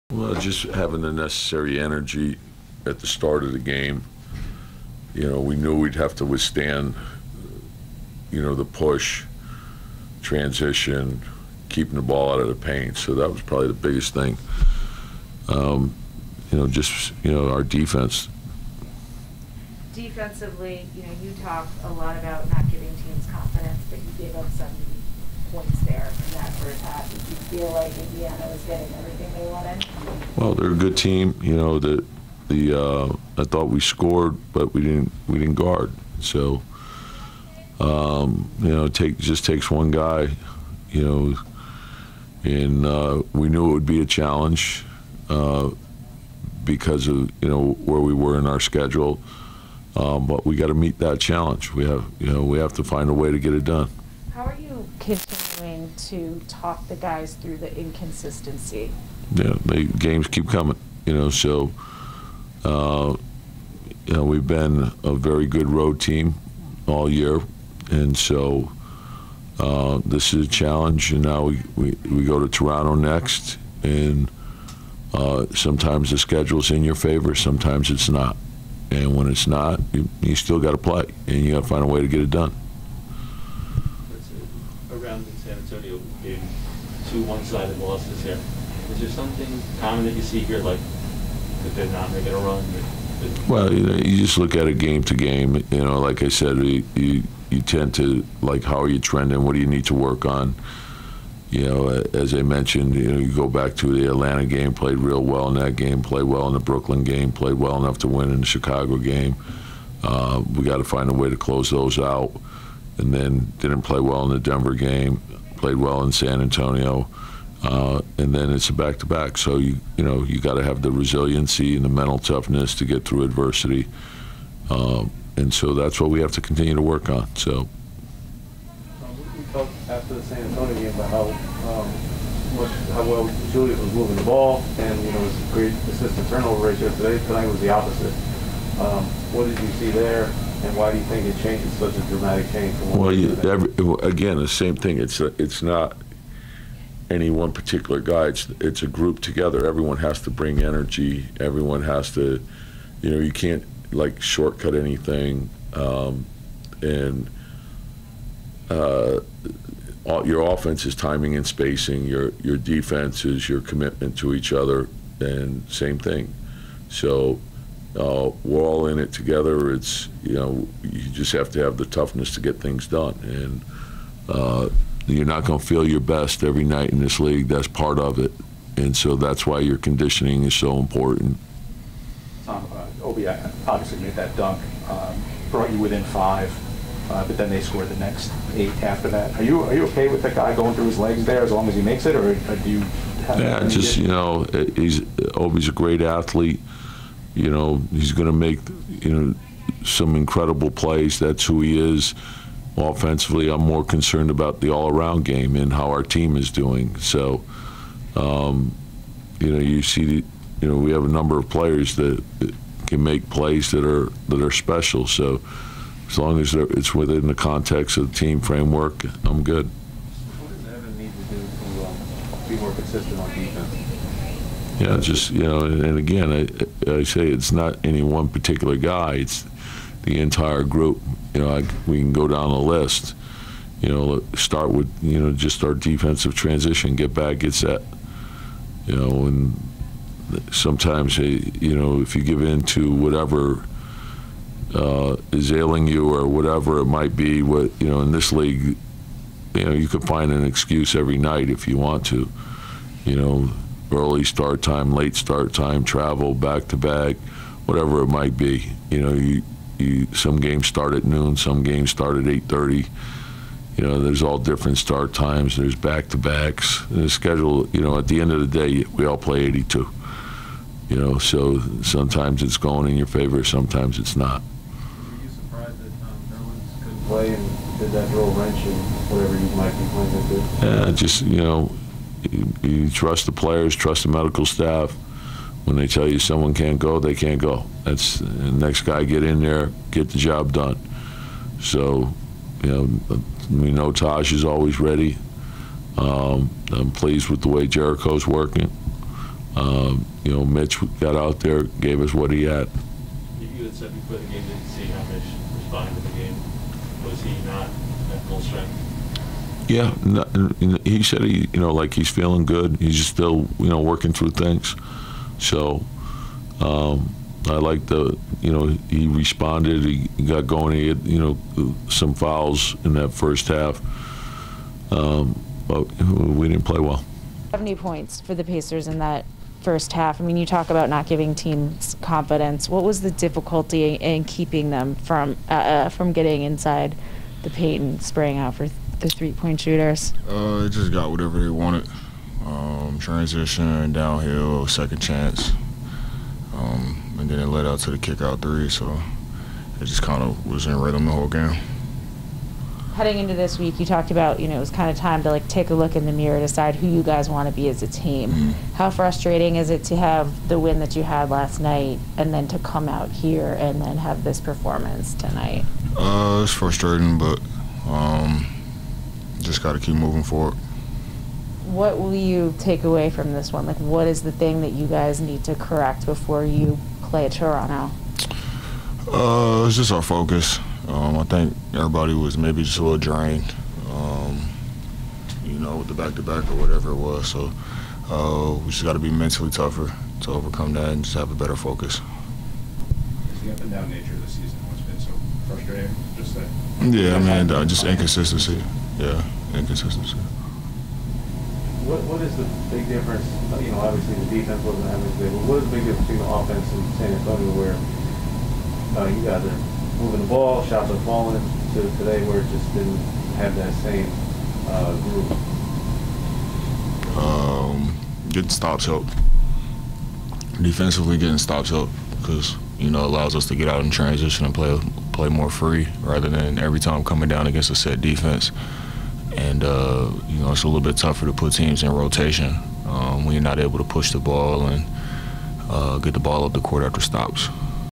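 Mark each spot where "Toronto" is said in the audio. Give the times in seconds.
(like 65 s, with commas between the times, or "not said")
72 s, 377 s.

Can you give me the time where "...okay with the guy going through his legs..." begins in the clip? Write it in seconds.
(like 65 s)
189 s.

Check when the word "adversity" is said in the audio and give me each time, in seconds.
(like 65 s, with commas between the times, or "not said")
123 s.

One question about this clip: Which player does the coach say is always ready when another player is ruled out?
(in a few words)
Taj.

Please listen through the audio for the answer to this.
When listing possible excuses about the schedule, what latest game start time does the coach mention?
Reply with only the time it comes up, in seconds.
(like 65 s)
262 s.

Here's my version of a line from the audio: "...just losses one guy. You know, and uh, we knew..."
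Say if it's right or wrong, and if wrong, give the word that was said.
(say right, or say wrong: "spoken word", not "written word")
wrong: "takes", not "losses".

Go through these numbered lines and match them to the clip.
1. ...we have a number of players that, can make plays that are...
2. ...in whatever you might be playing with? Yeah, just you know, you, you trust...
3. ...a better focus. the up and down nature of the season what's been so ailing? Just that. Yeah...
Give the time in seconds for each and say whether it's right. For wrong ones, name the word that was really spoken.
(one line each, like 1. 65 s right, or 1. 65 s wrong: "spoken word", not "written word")
1. 210 s right
2. 278 s right
3. 391 s wrong: "frustrating", not "ailing".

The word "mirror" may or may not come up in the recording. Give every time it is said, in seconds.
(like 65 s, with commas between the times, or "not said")
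356 s.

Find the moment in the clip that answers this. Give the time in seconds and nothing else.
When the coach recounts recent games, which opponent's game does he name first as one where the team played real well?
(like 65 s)
104 s.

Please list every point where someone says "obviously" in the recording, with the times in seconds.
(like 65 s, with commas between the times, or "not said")
183 s, 403 s.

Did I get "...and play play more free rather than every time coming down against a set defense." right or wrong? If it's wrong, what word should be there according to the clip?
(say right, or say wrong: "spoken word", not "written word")
right.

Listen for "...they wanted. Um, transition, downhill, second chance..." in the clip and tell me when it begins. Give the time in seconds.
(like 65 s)
341 s.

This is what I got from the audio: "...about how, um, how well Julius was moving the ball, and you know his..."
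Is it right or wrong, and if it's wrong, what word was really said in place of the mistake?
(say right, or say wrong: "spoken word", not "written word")
right.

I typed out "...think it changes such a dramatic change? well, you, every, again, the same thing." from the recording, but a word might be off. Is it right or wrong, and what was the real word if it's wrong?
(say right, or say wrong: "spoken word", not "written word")
right.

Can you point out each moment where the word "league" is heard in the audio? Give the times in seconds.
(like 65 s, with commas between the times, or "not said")
177 s, 248 s.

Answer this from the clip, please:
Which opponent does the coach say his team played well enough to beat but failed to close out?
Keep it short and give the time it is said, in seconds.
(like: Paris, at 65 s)
Chicago, at 108 s.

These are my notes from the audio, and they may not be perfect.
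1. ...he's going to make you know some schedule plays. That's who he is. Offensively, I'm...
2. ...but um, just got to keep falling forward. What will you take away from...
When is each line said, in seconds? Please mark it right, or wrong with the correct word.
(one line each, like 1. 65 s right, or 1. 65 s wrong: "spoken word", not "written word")
1. 197 s wrong: "incredible", not "schedule"
2. 367 s wrong: "moving", not "falling".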